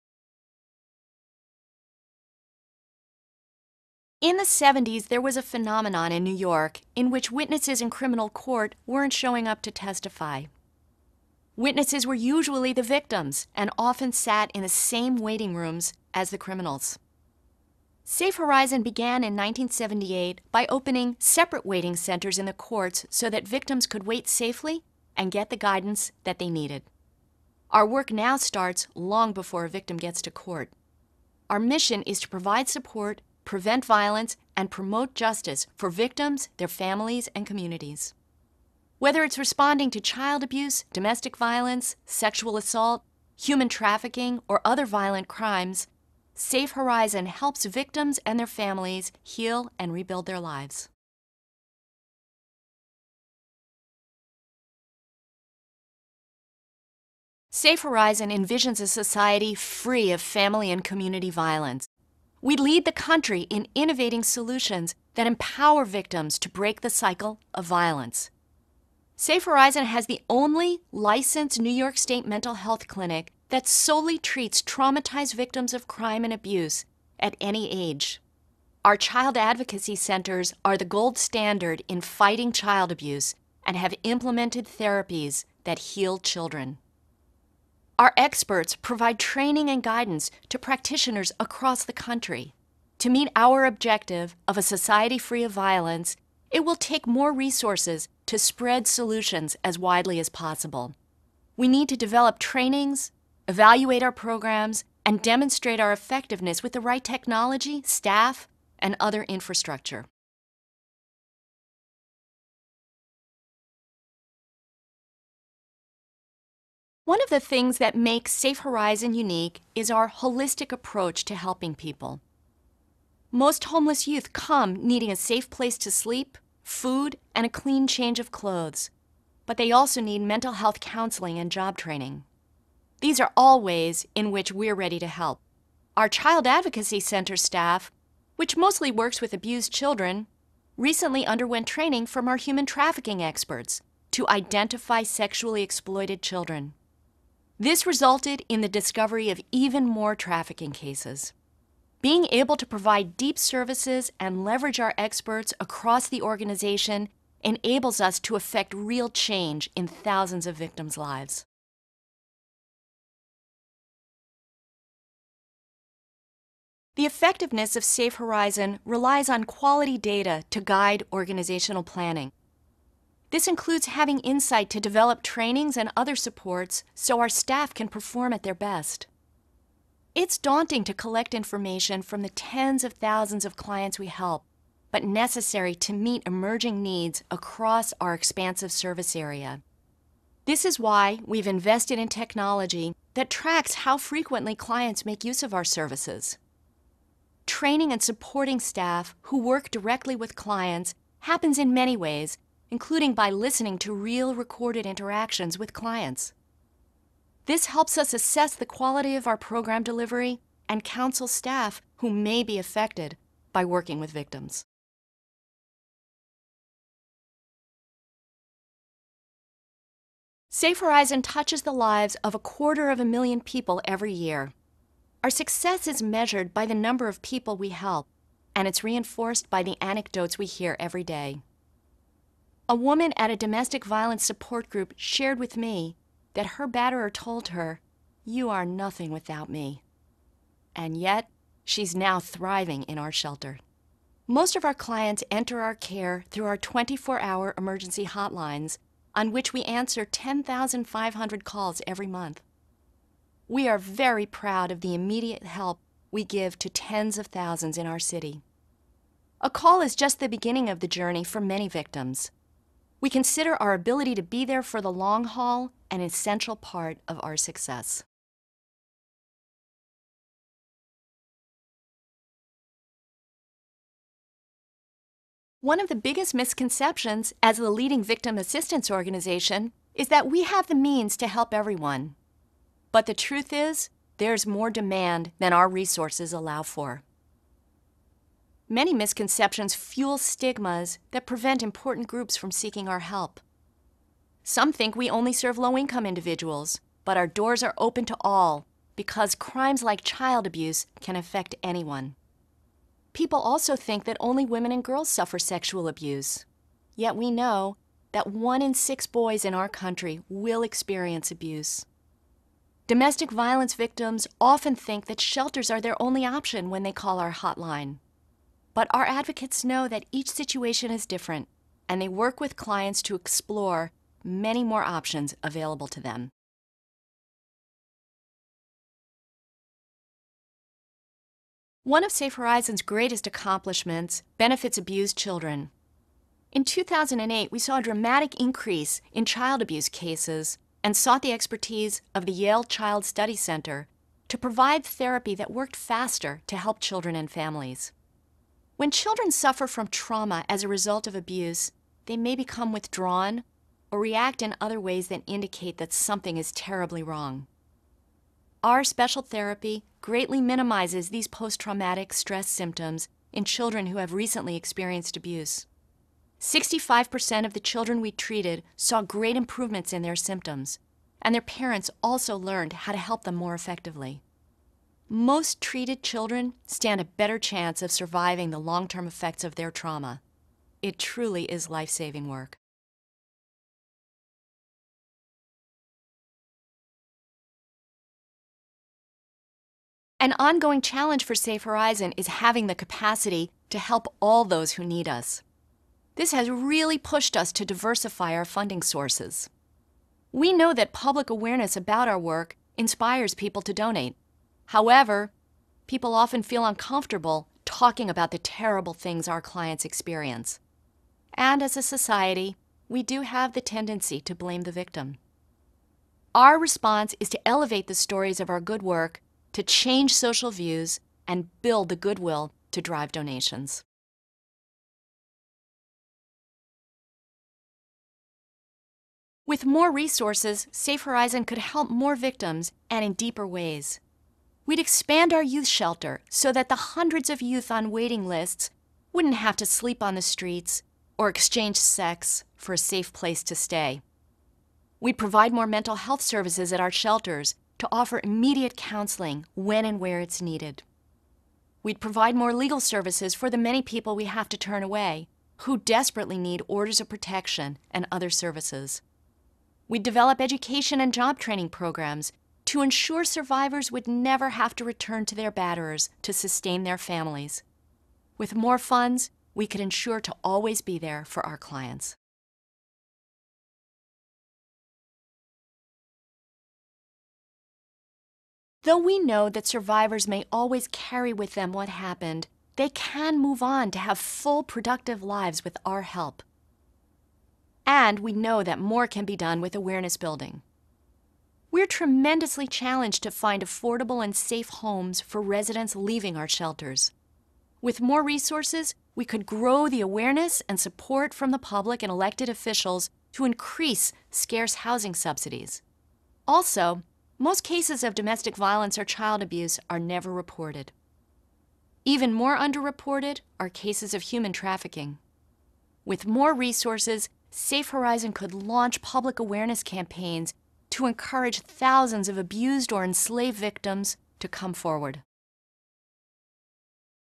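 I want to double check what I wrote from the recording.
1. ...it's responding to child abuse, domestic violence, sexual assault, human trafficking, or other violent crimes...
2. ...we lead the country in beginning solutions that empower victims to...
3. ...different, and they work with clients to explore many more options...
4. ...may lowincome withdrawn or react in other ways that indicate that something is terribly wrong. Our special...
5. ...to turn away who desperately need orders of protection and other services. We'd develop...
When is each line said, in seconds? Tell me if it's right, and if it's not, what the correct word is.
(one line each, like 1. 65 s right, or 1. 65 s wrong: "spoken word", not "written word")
1. 39 s right
2. 62 s wrong: "innovating", not "beginning"
3. 321 s right
4. 352 s wrong: "become", not "lowincome"
5. 454 s right.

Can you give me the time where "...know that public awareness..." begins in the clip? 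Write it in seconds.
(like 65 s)
400 s.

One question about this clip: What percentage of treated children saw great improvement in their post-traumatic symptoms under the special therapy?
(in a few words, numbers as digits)
65%.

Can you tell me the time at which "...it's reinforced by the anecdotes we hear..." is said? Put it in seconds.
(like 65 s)
228 s.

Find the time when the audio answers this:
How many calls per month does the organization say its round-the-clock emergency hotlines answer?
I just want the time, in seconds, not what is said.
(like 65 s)
250 s.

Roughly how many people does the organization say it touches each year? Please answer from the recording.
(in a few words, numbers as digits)
a quarter of a million.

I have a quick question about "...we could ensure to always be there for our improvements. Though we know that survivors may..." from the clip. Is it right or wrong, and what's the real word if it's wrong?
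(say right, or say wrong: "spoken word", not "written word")
wrong: "clients", not "improvements".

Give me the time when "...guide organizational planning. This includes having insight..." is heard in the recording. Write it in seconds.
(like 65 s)
170 s.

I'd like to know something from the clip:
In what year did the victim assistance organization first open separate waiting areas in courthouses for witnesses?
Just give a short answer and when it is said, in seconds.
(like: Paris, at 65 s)
1978, at 19 s.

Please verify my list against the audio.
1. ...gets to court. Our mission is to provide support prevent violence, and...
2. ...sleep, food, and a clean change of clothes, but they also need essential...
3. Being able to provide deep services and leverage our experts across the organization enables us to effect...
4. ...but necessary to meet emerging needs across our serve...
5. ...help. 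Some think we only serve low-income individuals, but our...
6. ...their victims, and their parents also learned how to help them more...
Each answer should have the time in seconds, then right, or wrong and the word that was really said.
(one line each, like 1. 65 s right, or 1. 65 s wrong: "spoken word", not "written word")
1. 29 s right
2. 125 s wrong: "mental", not "essential"
3. 152 s right
4. 184 s wrong: "expansive", not "serve"
5. 293 s right
6. 370 s wrong: "symptoms", not "victims".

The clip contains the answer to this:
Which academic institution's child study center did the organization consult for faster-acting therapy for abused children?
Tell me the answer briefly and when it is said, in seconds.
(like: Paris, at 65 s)
Yale, at 342 s.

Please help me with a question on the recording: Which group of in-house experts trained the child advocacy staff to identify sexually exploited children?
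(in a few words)
human trafficking experts.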